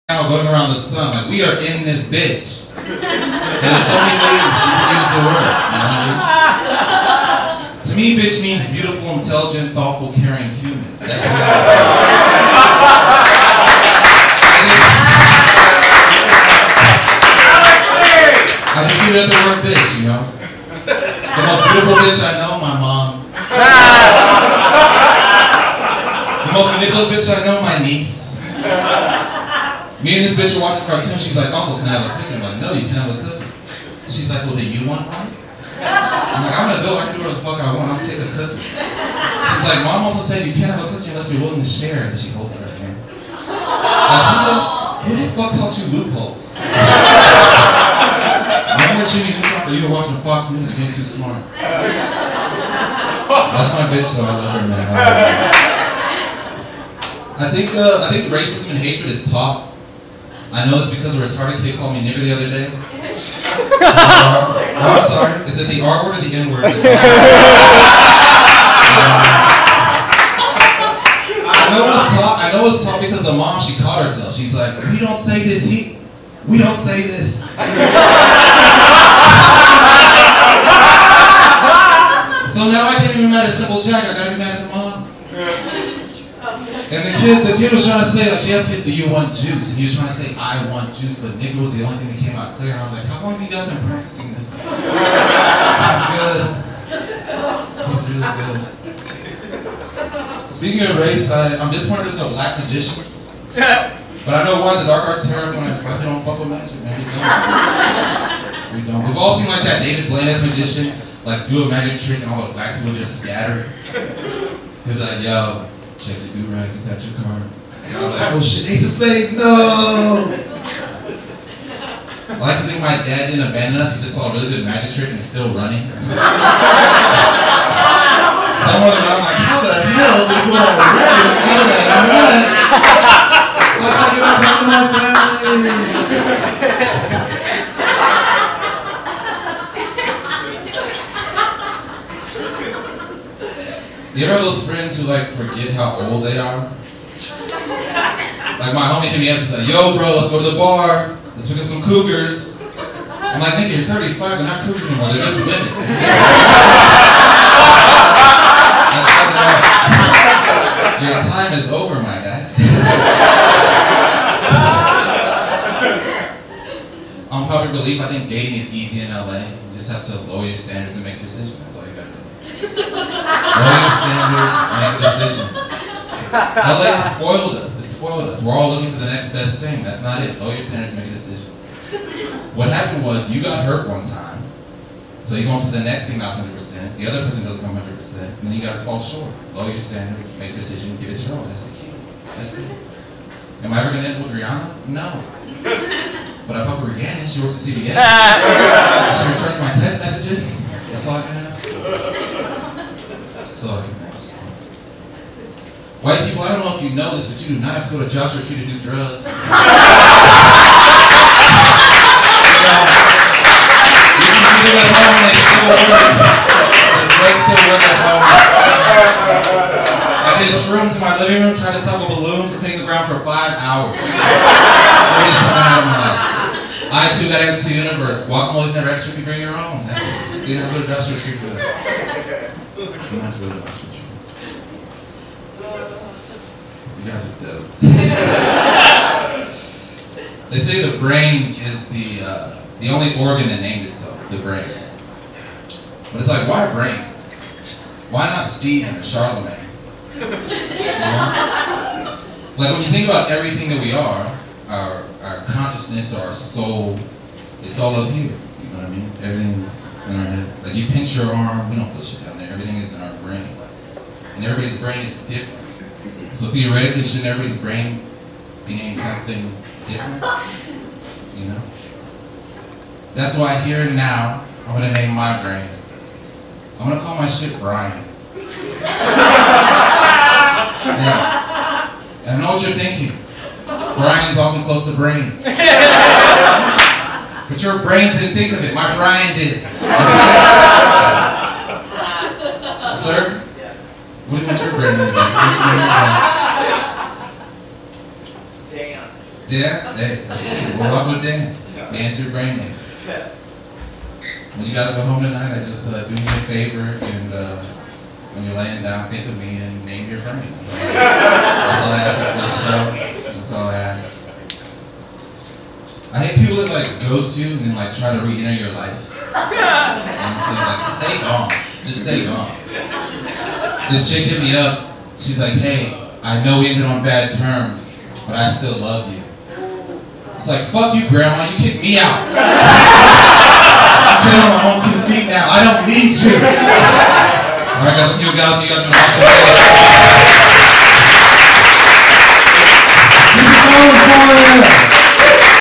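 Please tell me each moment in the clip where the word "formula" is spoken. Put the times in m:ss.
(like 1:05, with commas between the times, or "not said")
not said.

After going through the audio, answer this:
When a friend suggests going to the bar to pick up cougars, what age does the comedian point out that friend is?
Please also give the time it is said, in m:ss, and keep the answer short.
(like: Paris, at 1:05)
35, at 2:33.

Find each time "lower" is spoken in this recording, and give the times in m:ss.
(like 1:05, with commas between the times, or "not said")
2:50, 3:00, 3:09.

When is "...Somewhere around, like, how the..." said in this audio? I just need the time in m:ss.
2:08.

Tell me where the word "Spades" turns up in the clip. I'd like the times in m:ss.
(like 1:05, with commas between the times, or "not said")
1:58.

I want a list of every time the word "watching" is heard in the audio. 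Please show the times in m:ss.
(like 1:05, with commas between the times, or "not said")
0:30, 0:50.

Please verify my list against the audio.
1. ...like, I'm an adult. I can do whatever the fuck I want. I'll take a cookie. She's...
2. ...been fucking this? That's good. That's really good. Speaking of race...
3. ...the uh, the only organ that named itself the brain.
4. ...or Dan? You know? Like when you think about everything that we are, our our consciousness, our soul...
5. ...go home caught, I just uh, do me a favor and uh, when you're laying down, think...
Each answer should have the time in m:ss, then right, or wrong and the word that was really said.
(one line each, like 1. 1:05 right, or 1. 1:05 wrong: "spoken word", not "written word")
1. 0:36 right
2. 1:33 wrong: "practicing", not "fucking"
3. 4:01 right
4. 4:08 wrong: "Charlemagne", not "Dan"
5. 5:04 wrong: "tonight", not "caught".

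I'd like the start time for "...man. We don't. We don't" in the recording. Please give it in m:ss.
1:46.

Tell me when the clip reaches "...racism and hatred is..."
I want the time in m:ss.
0:58.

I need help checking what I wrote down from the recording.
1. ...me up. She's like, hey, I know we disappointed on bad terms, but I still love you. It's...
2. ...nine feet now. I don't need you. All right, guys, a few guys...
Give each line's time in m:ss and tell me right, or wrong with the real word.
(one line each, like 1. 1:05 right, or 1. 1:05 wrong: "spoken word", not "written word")
1. 5:24 wrong: "ended", not "disappointed"
2. 5:34 wrong: "two", not "nine".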